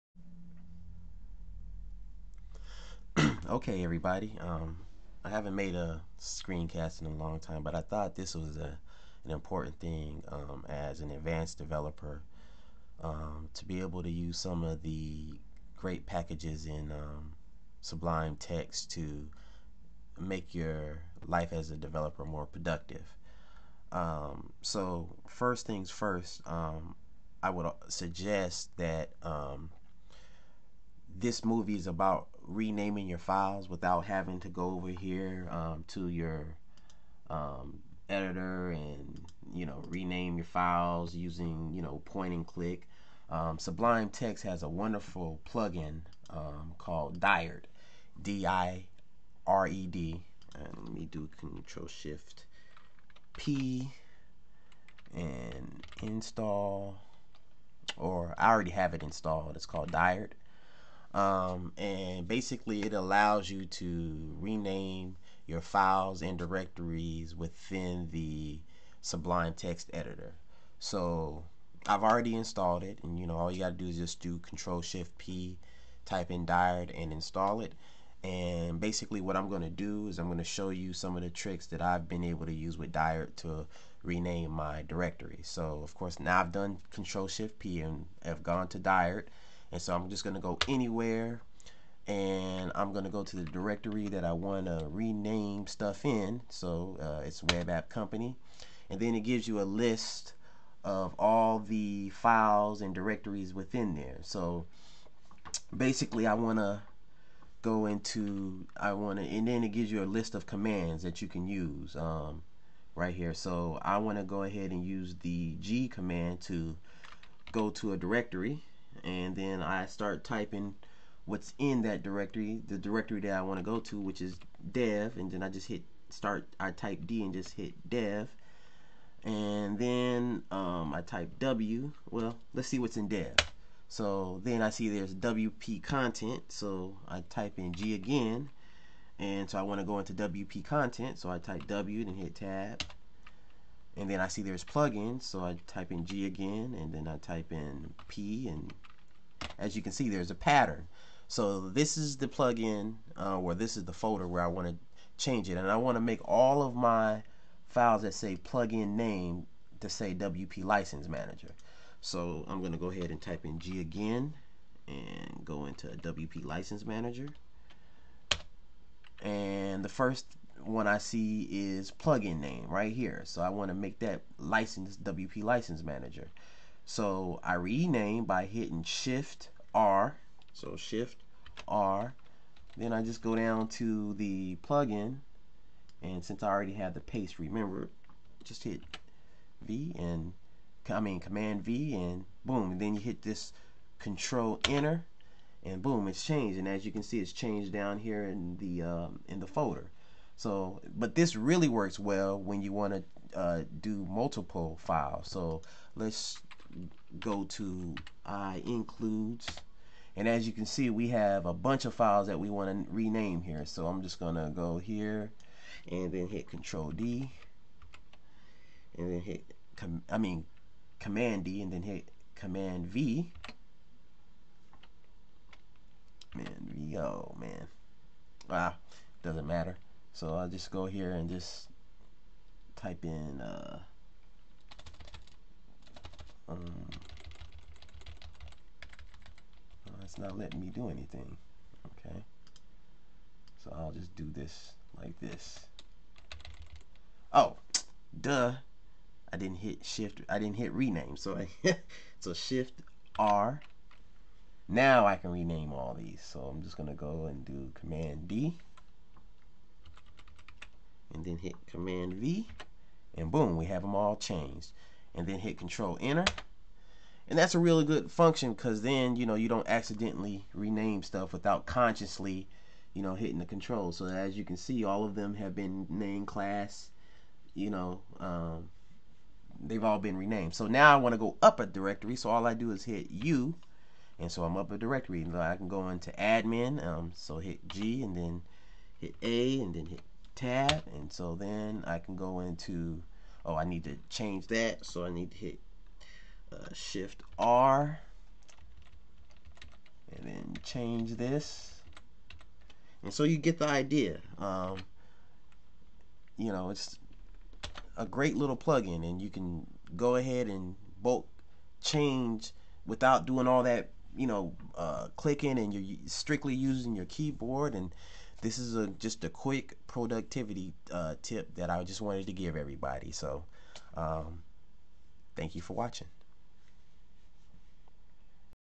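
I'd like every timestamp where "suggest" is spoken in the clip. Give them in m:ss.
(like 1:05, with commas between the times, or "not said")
0:27.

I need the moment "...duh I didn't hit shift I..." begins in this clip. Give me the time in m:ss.
4:08.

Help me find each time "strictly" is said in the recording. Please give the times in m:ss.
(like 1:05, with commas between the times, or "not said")
5:16.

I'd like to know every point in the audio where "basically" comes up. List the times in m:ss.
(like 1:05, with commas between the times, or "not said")
1:02, 1:18, 1:45.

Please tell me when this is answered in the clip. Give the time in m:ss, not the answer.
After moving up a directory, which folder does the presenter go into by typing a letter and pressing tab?
4:46.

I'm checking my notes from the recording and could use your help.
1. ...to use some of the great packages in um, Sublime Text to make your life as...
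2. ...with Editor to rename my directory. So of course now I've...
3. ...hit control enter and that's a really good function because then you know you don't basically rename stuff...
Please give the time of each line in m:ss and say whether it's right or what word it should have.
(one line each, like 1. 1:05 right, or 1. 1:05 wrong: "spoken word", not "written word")
1. 0:14 right
2. 1:22 wrong: "Dired", not "Editor"
3. 4:25 wrong: "accidentally", not "basically".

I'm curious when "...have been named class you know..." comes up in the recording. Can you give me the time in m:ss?
4:35.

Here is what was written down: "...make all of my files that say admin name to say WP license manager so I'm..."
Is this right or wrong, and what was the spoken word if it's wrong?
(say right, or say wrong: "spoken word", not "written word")
wrong: "plugin", not "admin".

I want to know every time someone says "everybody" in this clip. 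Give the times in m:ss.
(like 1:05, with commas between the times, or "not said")
0:03, 5:22.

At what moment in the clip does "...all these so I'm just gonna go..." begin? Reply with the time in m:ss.
4:15.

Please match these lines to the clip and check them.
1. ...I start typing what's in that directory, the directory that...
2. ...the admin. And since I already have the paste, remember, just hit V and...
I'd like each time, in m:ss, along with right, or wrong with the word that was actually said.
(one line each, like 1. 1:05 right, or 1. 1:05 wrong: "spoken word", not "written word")
1. 1:59 right
2. 3:04 wrong: "plugin", not "admin".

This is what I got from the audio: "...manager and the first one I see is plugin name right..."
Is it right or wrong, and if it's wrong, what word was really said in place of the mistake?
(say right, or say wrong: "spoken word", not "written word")
right.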